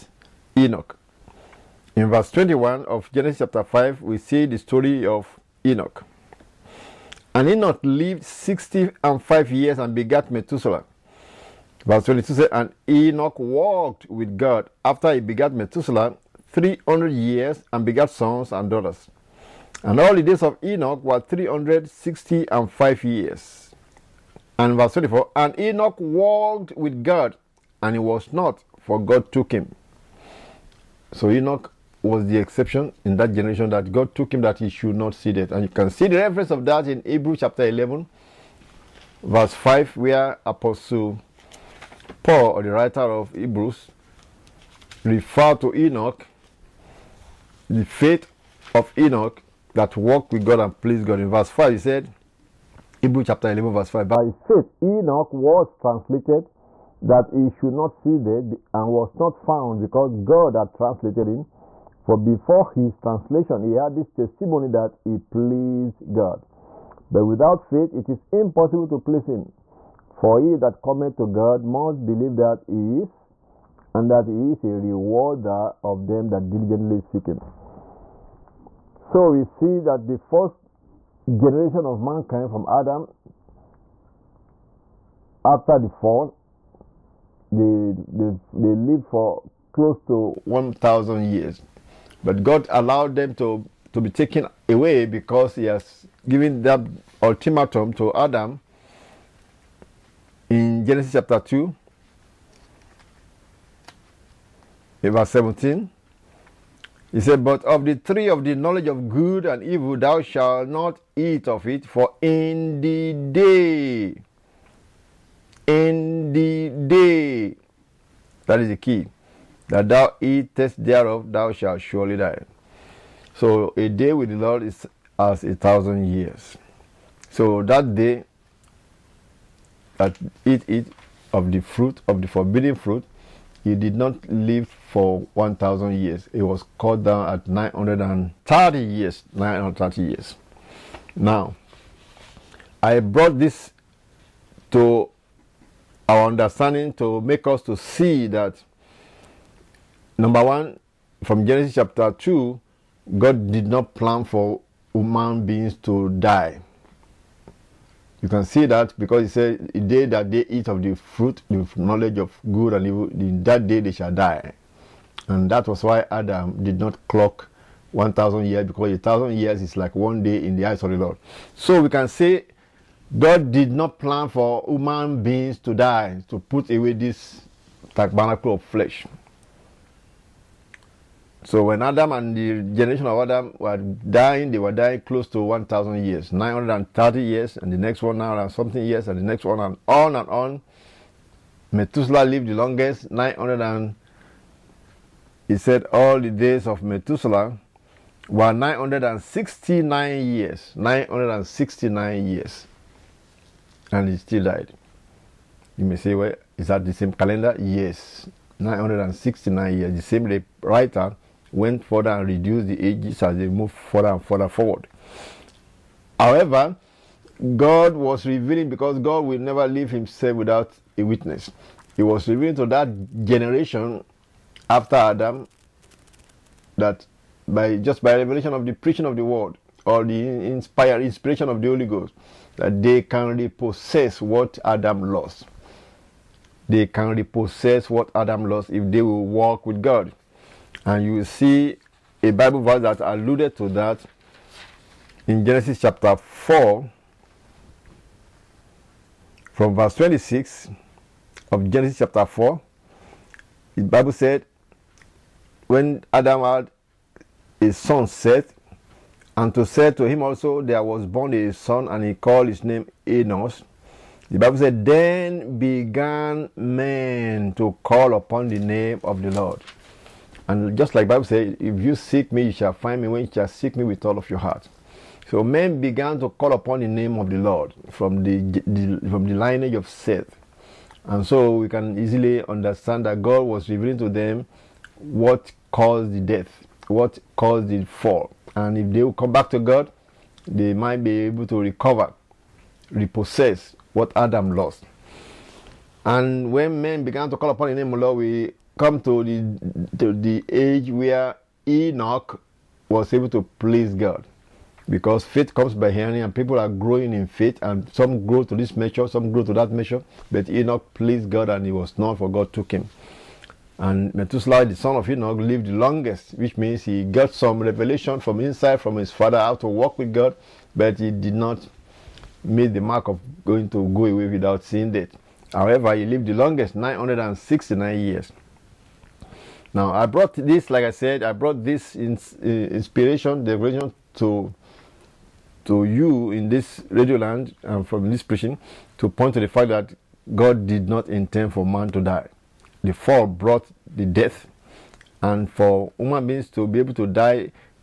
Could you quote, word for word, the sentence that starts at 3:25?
You may say, well, is that the same calendar?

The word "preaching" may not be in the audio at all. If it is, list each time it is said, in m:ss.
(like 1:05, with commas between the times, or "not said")
3:48, 5:38.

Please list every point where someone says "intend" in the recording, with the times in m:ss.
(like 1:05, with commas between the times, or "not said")
5:41.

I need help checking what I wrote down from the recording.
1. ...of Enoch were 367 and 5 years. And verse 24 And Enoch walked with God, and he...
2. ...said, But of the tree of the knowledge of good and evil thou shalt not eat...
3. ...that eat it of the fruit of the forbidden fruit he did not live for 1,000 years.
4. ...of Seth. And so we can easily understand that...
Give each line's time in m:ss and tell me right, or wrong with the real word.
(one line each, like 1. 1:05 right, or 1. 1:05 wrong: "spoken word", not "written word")
1. 0:20 wrong: "360", not "367"
2. 1:47 right
3. 2:09 right
4. 4:39 right.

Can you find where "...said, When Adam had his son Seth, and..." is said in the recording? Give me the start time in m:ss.
4:14.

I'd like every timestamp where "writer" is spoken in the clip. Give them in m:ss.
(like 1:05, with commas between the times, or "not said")
0:42, 3:30.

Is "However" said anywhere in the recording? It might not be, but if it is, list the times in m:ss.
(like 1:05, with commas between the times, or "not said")
3:36, 5:25.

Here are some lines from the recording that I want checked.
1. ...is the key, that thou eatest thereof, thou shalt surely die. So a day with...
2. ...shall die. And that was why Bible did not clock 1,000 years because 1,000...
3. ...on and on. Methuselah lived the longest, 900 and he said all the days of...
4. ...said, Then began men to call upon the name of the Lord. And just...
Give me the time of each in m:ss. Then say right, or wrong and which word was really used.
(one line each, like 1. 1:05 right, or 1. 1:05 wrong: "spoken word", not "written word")
1. 1:58 right
2. 2:43 wrong: "Adam", not "Bible"
3. 3:09 right
4. 4:24 right.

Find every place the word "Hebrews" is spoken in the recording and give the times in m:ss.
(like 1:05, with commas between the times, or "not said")
0:37, 0:43, 0:53.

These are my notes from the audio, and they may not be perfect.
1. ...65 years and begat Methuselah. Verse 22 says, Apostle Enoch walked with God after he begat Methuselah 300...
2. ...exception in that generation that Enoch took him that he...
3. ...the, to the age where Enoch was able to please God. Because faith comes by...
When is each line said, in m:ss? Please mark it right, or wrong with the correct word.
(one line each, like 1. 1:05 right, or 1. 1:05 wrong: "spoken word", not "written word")
1. 0:08 wrong: "And", not "Apostle"
2. 0:32 wrong: "God", not "Enoch"
3. 4:59 right.